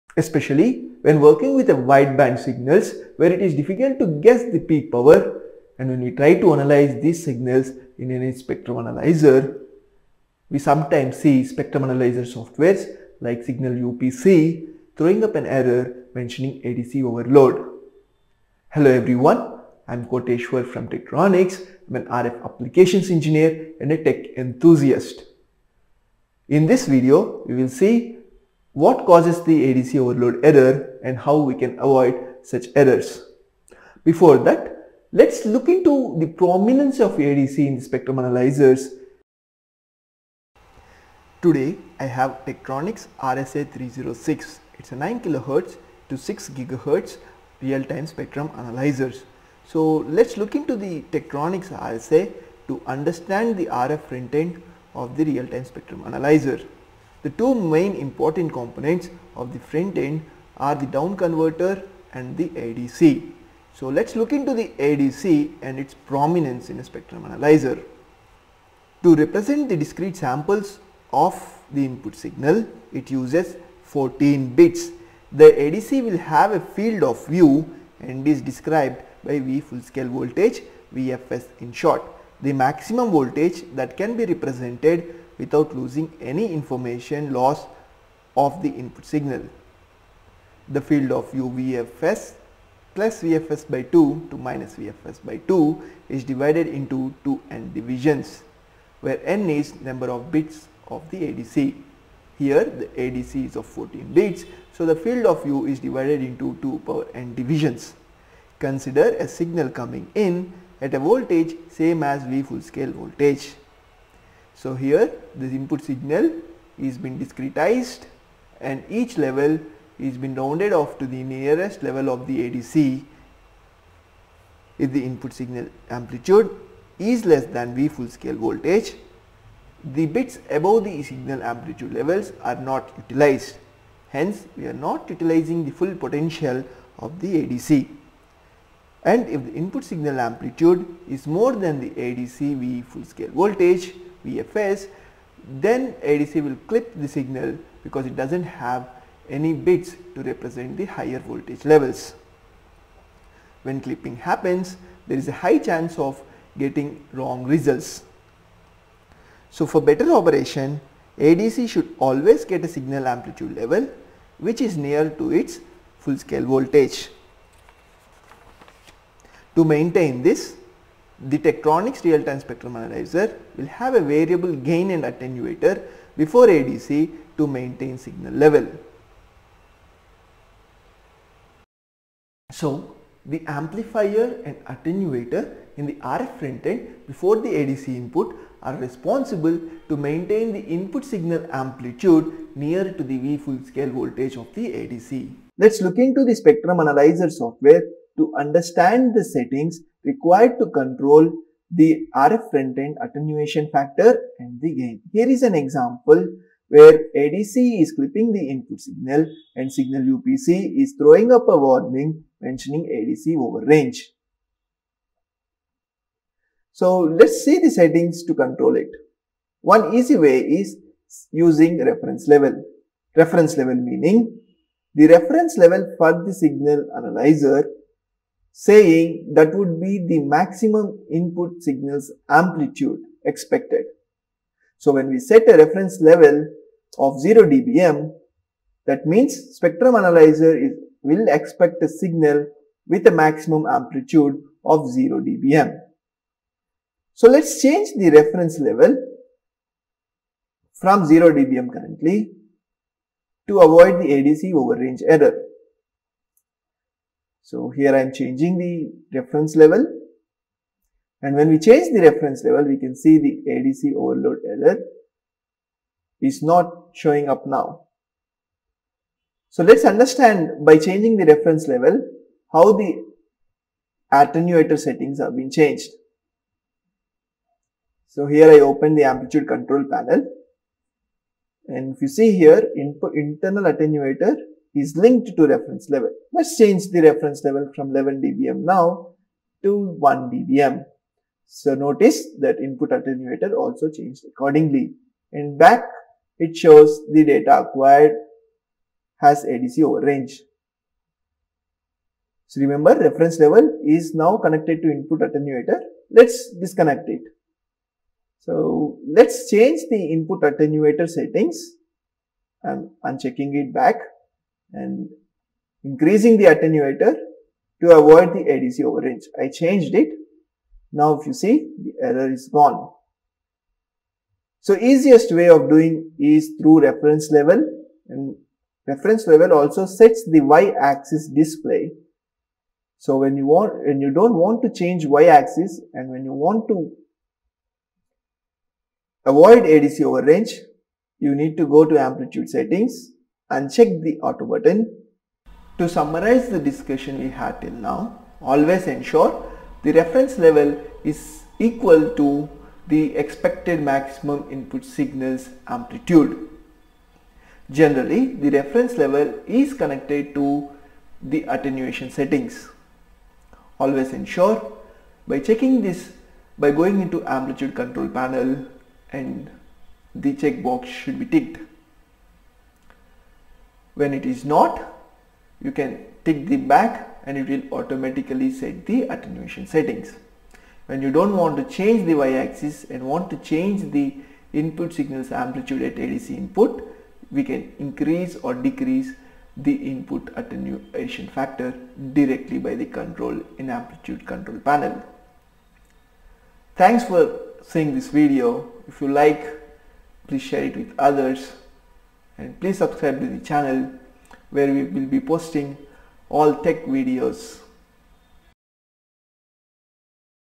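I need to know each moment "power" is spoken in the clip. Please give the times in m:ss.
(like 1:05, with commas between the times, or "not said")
0:04, 1:46.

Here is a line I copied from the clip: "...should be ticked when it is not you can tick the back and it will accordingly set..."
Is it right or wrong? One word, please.
wrong.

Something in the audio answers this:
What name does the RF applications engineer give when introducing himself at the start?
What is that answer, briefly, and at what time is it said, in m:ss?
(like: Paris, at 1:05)
Koteshwar, at 0:20.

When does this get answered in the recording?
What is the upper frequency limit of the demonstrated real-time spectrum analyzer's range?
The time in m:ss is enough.
0:46.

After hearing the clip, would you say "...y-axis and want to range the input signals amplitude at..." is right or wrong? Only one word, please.
wrong.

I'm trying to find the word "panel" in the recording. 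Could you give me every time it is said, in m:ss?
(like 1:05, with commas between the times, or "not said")
4:39, 6:08, 6:34.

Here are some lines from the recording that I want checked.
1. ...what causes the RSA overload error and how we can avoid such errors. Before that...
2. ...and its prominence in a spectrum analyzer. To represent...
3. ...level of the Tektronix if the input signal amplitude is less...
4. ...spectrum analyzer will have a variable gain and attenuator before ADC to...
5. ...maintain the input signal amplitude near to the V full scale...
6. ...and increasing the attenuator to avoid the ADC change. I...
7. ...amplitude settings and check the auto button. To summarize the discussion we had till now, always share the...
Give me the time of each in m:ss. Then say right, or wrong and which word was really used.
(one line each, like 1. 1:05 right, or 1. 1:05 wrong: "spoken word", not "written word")
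1. 0:28 wrong: "ADC", not "RSA"
2. 1:05 right
3. 2:01 wrong: "ADC", not "Tektronix"
4. 2:52 right
5. 3:09 right
6. 5:14 wrong: "overrange", not "change"
7. 5:41 wrong: "ensure", not "share".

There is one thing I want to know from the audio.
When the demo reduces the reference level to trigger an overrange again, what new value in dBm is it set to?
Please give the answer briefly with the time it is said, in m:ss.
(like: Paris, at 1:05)
1 dBm, at 4:49.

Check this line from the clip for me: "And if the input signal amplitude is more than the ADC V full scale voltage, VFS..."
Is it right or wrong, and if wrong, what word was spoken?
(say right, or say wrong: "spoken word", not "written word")
right.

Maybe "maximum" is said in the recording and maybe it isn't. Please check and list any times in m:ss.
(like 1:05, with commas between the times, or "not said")
1:22, 3:50, 4:03, 5:53.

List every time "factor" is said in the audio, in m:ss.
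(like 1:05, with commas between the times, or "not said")
3:23, 6:31.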